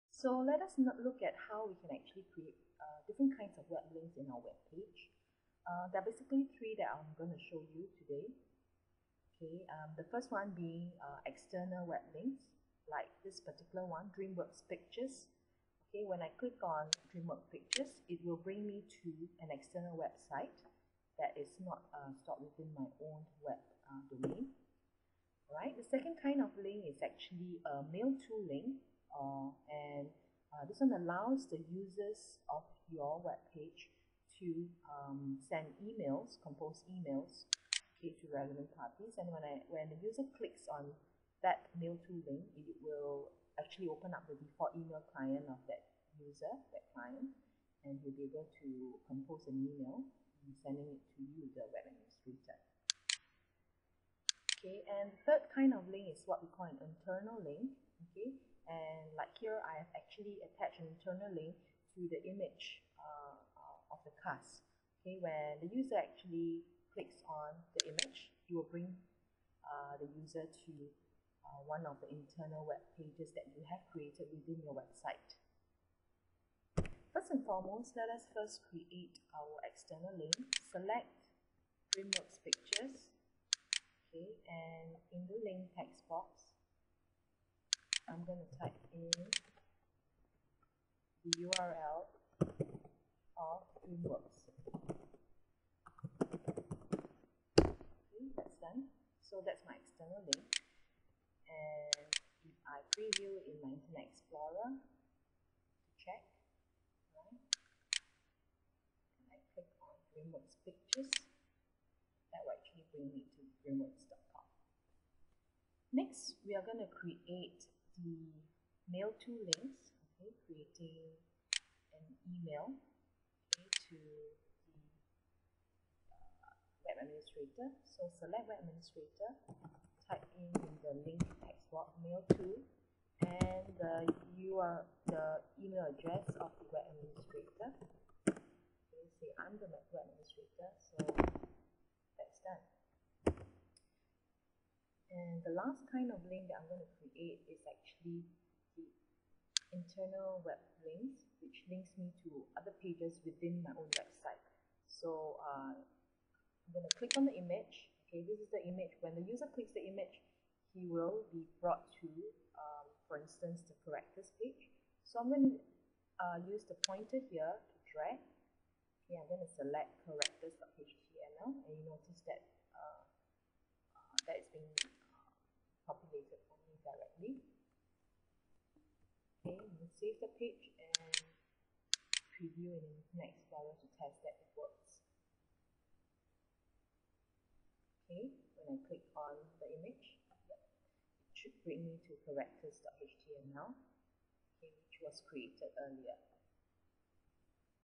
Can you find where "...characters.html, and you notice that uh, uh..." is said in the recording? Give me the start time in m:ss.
2:50.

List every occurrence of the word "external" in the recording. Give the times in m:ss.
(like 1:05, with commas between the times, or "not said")
0:11, 0:19, 1:19, 1:39.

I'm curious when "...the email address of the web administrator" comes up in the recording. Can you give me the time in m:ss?
2:15.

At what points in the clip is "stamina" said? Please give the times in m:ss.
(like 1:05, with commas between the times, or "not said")
not said.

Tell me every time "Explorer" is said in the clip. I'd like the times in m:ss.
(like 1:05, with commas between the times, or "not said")
1:44, 3:03.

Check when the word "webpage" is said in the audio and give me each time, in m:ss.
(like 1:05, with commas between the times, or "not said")
0:33.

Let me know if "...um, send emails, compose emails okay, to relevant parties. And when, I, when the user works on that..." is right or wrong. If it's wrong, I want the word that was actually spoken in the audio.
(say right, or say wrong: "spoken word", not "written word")
wrong: "clicks", not "works".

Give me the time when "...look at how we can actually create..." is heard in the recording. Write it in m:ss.
0:00.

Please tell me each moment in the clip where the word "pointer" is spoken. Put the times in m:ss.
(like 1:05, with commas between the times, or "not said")
2:46.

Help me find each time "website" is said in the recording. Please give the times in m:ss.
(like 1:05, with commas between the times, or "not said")
0:19, 1:14, 2:33.